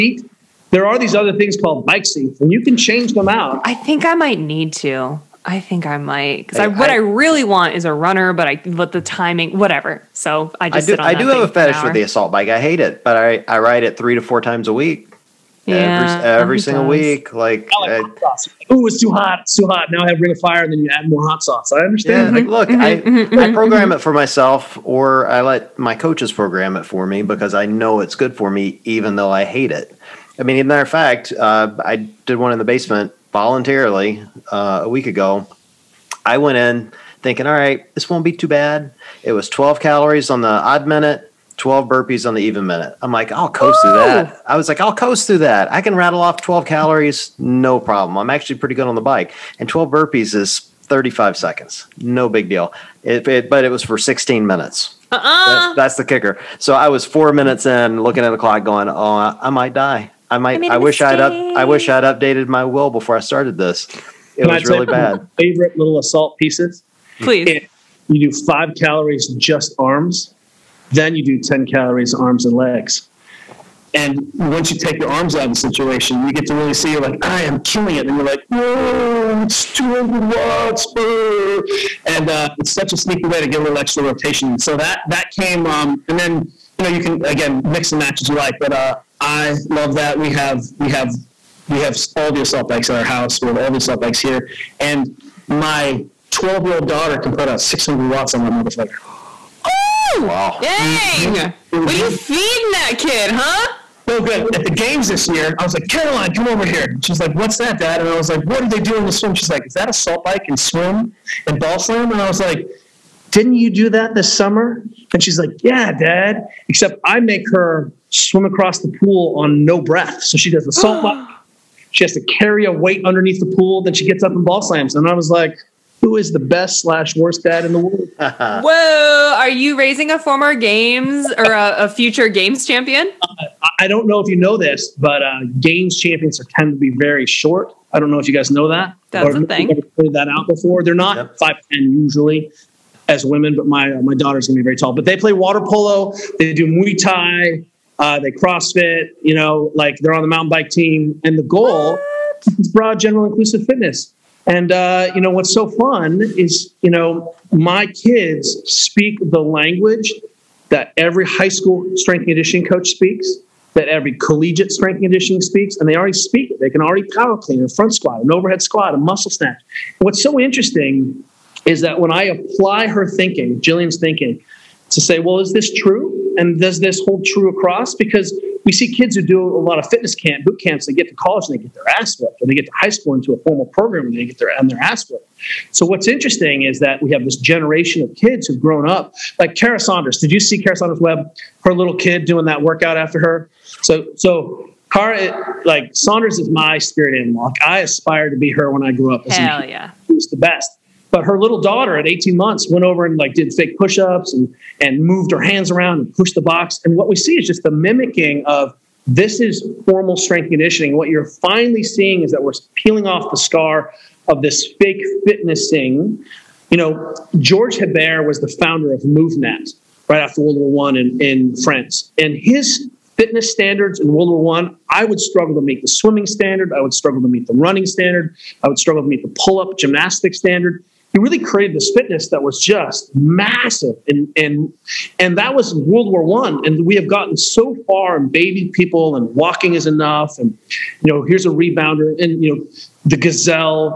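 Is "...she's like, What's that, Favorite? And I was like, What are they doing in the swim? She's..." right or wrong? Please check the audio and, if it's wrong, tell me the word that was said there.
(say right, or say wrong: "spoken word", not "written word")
wrong: "Dad", not "Favorite".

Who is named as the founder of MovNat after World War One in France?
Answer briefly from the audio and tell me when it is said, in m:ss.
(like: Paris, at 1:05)
George Hebert, at 3:37.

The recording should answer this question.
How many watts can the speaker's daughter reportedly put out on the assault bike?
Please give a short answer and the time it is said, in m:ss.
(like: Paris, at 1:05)
600, at 1:37.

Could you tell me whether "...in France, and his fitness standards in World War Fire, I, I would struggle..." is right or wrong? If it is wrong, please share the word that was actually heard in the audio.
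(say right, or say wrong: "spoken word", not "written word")
wrong: "One", not "Fire".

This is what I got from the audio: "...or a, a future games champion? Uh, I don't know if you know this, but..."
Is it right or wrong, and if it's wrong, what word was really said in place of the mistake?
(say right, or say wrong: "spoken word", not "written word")
right.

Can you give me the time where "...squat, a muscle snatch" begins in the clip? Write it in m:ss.
2:48.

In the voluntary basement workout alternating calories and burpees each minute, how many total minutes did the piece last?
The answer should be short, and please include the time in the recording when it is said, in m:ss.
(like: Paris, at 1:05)
16, at 0:53.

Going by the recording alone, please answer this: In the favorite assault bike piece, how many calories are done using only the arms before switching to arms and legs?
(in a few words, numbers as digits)
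5.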